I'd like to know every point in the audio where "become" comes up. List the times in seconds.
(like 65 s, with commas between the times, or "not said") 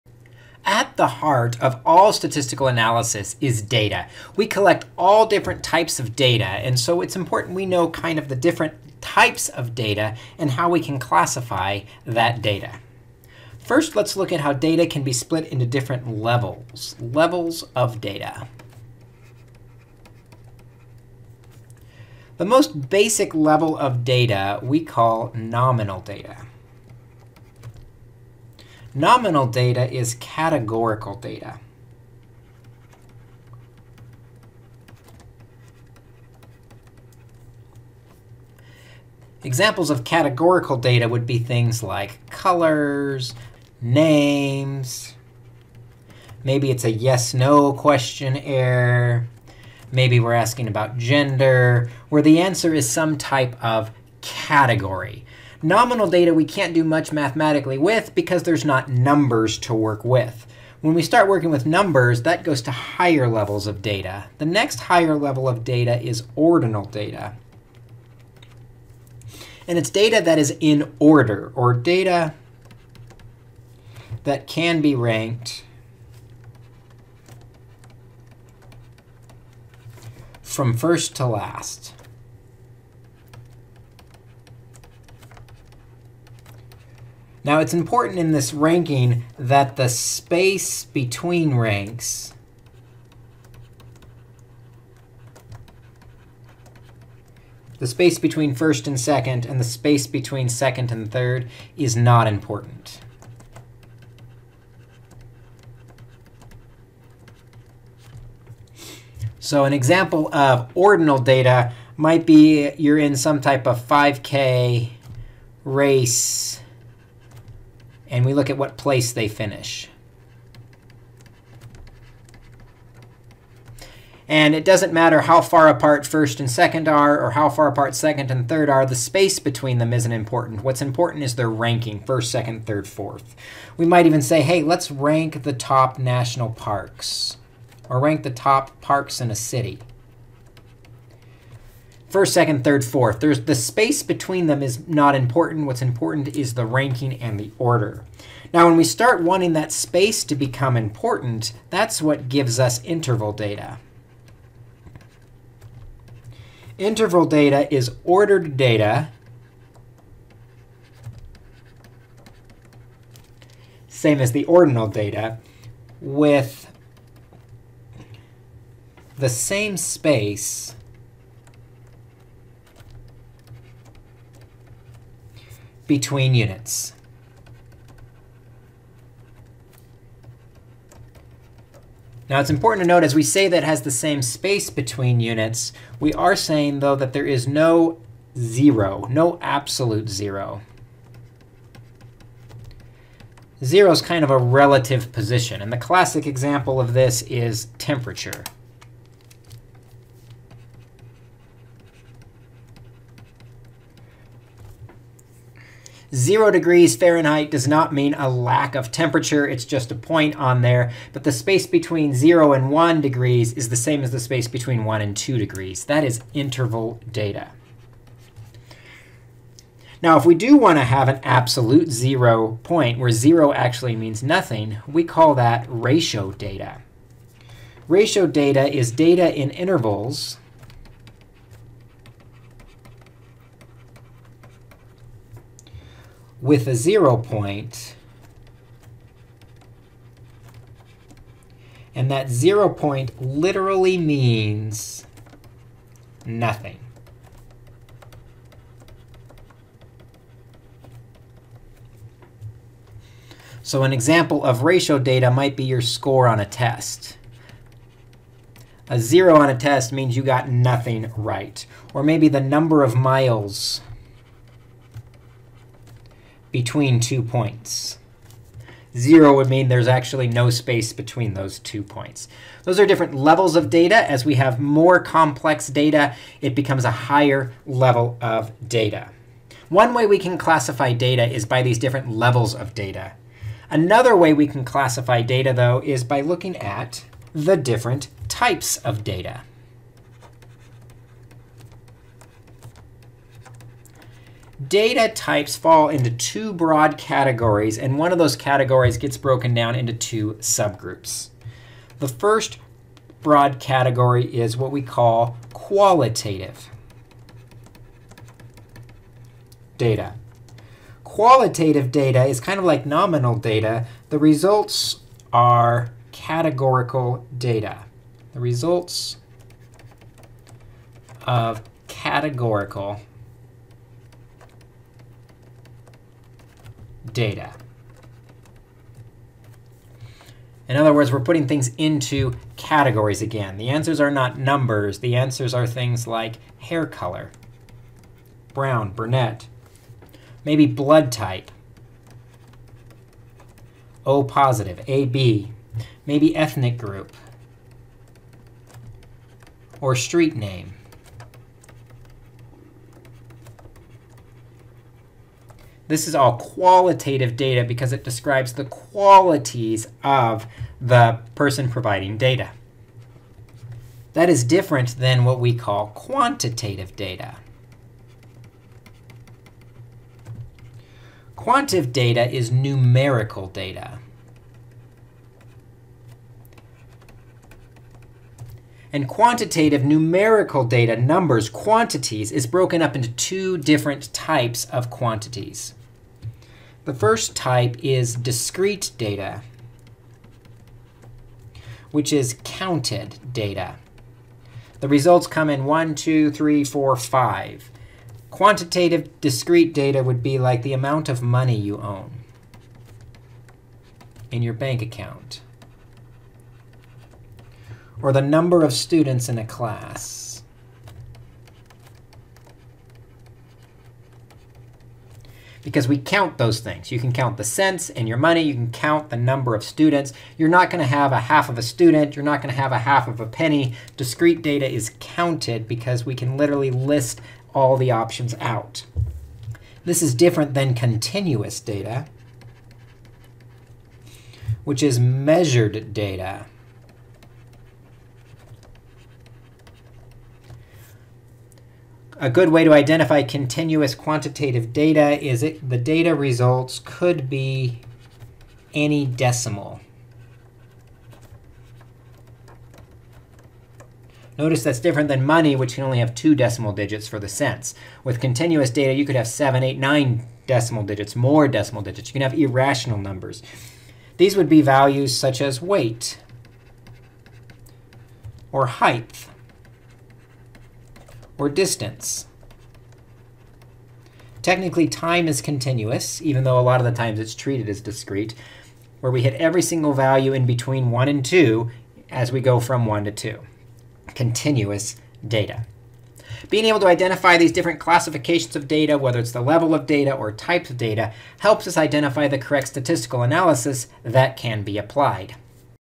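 150 s, 276 s.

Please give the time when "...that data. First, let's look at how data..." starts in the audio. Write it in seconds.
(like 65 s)
12 s.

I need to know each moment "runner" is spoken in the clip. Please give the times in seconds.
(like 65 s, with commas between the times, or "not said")
not said.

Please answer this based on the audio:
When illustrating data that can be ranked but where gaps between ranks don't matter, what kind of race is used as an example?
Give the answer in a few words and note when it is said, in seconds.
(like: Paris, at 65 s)
5K race, at 113 s.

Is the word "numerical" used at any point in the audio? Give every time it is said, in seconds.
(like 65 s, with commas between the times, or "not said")
372 s, 379 s.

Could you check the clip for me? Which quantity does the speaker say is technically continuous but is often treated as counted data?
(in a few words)
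Time.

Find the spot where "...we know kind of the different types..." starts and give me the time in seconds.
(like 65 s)
7 s.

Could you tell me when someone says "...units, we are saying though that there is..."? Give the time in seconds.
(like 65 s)
185 s.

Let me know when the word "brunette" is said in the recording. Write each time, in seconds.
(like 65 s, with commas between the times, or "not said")
338 s.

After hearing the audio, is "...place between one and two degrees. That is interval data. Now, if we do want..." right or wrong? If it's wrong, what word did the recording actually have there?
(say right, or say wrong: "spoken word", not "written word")
wrong: "space", not "place".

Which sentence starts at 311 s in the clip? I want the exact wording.
Qualitative data is kind of like nominal data.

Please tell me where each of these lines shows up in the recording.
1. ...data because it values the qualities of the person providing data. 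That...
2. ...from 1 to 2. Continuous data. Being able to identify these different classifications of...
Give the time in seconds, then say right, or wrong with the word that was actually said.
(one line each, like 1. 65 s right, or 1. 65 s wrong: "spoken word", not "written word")
1. 357 s wrong: "describes", not "values"
2. 482 s right.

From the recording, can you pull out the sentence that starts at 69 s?
And it's data that is in order, or data that can be ranked from first to last.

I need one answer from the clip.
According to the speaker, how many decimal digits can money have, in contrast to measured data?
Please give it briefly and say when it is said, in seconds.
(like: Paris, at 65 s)
2, at 456 s.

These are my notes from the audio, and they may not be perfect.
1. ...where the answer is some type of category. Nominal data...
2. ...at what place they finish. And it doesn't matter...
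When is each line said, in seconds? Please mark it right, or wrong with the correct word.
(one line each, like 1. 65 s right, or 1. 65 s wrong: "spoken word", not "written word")
1. 52 s right
2. 118 s right.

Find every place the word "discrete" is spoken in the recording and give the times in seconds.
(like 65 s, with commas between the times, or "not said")
388 s, 399 s, 423 s, 477 s.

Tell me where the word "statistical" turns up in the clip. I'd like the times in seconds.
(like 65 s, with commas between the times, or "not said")
2 s, 492 s.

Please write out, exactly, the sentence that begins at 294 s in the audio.
data types fall into two broad categories, and one of those categories gets broken down into two subgroups.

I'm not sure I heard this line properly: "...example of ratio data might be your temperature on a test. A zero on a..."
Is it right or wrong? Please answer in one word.
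wrong.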